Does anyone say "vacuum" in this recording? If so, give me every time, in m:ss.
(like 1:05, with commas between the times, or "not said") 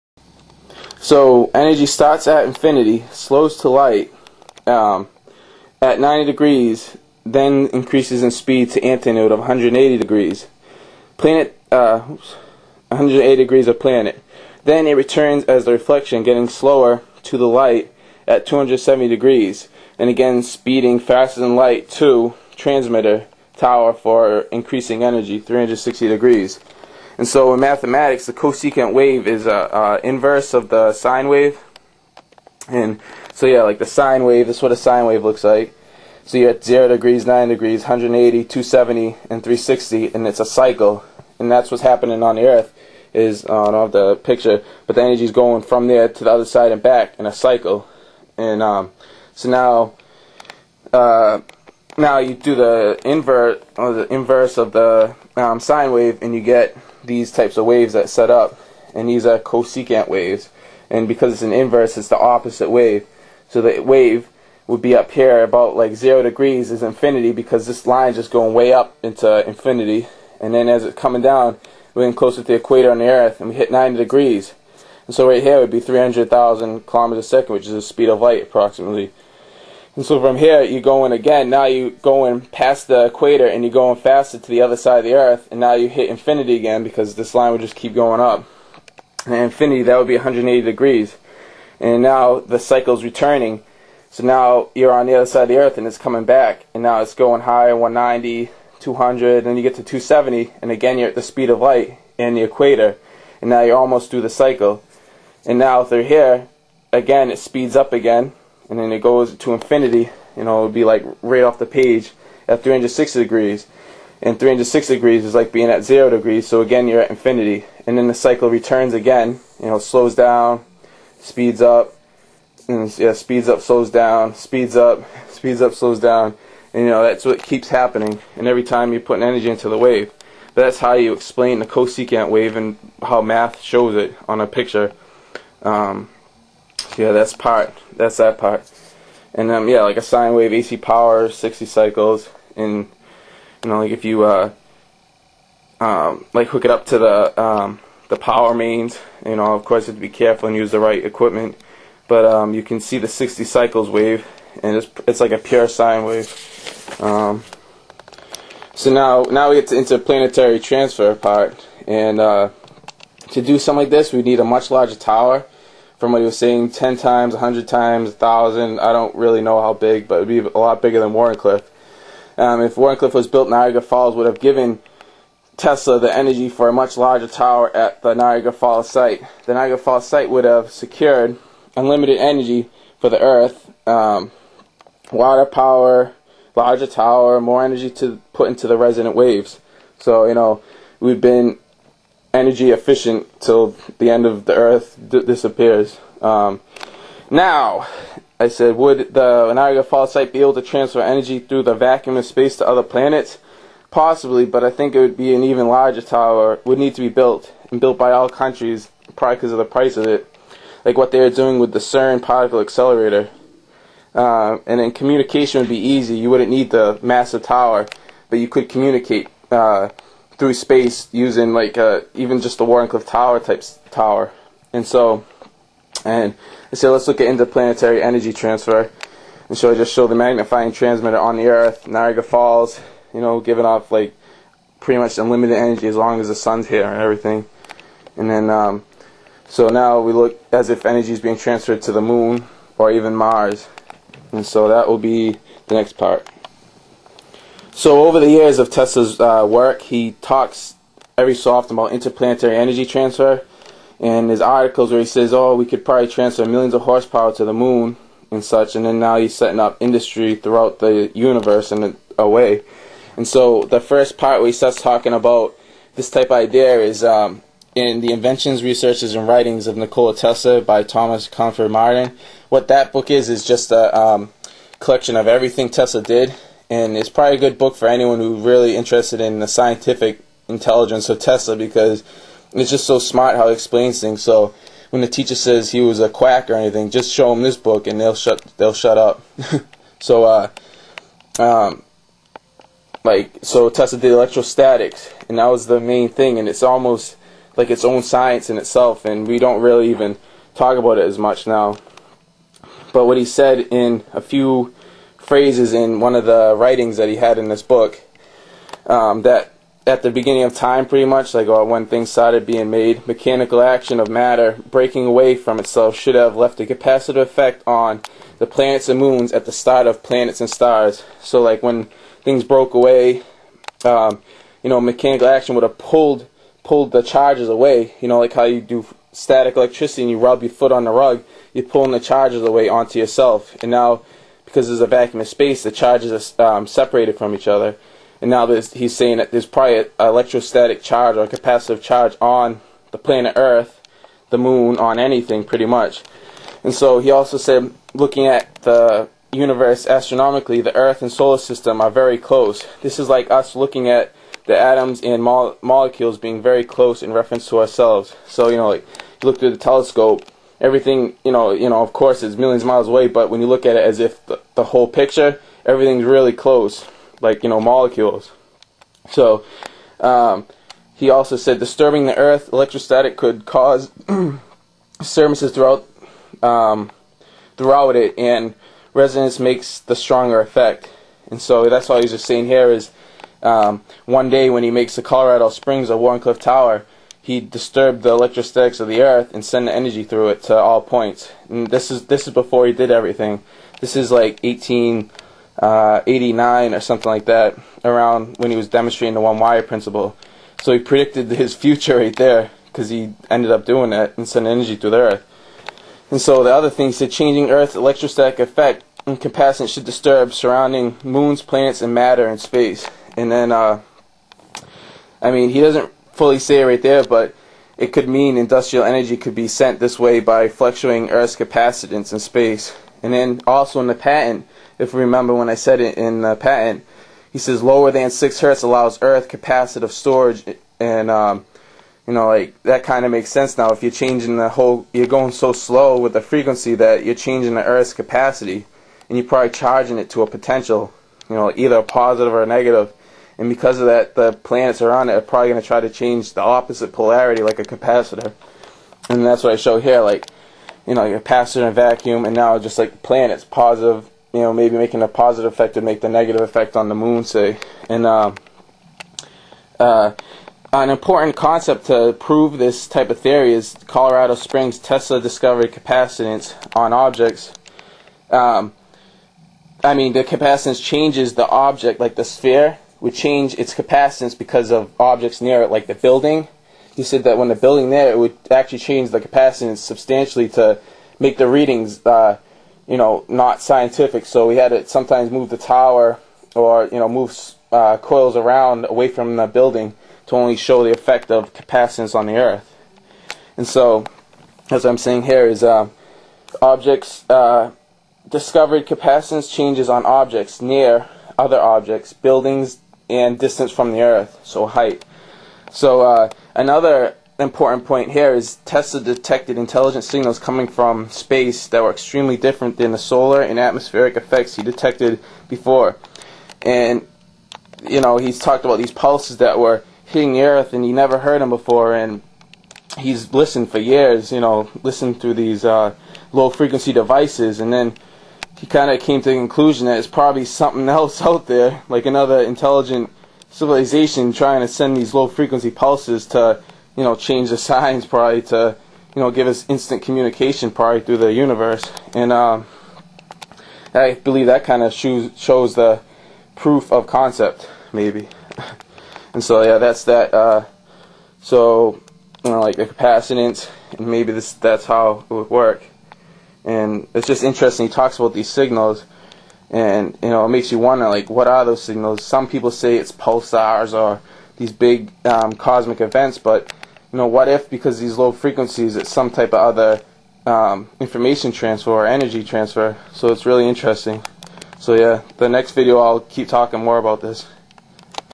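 3:21, 5:34, 7:31.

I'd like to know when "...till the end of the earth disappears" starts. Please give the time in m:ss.
3:13.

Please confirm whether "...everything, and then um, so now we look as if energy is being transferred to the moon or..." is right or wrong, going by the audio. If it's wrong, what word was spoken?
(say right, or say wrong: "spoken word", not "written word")
right.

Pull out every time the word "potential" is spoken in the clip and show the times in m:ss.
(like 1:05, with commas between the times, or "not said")
7:20.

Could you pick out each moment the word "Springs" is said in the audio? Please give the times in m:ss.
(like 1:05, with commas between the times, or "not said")
6:25, 7:44.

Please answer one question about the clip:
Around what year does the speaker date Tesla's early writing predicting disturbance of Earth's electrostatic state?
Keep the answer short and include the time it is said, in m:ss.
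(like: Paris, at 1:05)
1889, at 6:34.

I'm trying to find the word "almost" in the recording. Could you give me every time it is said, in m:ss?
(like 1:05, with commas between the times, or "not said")
1:43, 4:56.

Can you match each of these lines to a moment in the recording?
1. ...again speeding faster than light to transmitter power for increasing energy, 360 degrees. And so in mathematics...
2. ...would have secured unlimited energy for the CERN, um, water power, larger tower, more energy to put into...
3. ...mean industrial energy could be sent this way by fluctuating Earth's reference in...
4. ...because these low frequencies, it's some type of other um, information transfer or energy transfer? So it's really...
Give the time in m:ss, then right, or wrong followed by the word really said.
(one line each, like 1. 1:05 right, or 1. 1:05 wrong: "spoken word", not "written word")
1. 0:20 wrong: "tower", not "power"
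2. 3:00 wrong: "Earth", not "CERN"
3. 6:58 wrong: "capacitance", not "reference"
4. 9:27 right.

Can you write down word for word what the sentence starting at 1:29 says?
And infinity, that would be 180 degrees.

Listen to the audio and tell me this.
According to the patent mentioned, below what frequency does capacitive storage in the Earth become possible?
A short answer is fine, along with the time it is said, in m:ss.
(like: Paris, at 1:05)
6 hertz, at 7:08.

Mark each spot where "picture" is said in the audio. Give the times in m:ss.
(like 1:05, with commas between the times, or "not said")
0:44, 2:14, 6:04.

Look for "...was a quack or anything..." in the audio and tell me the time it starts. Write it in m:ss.
4:45.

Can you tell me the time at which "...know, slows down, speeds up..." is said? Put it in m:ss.
1:59.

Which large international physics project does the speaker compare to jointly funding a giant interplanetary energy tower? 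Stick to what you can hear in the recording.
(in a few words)
CERN particle accelerator.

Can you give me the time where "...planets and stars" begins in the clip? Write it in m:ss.
5:20.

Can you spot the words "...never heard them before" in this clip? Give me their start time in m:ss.
8:40.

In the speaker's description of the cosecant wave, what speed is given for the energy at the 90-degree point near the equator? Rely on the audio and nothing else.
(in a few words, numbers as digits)
300,000 km per second.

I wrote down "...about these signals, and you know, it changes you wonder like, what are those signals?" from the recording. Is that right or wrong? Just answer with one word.
wrong.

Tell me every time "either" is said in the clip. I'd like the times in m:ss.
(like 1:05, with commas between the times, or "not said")
7:21.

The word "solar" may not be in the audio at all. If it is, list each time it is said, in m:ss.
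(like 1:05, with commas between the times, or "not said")
5:51, 8:32.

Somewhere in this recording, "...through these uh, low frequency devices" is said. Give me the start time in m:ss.
8:45.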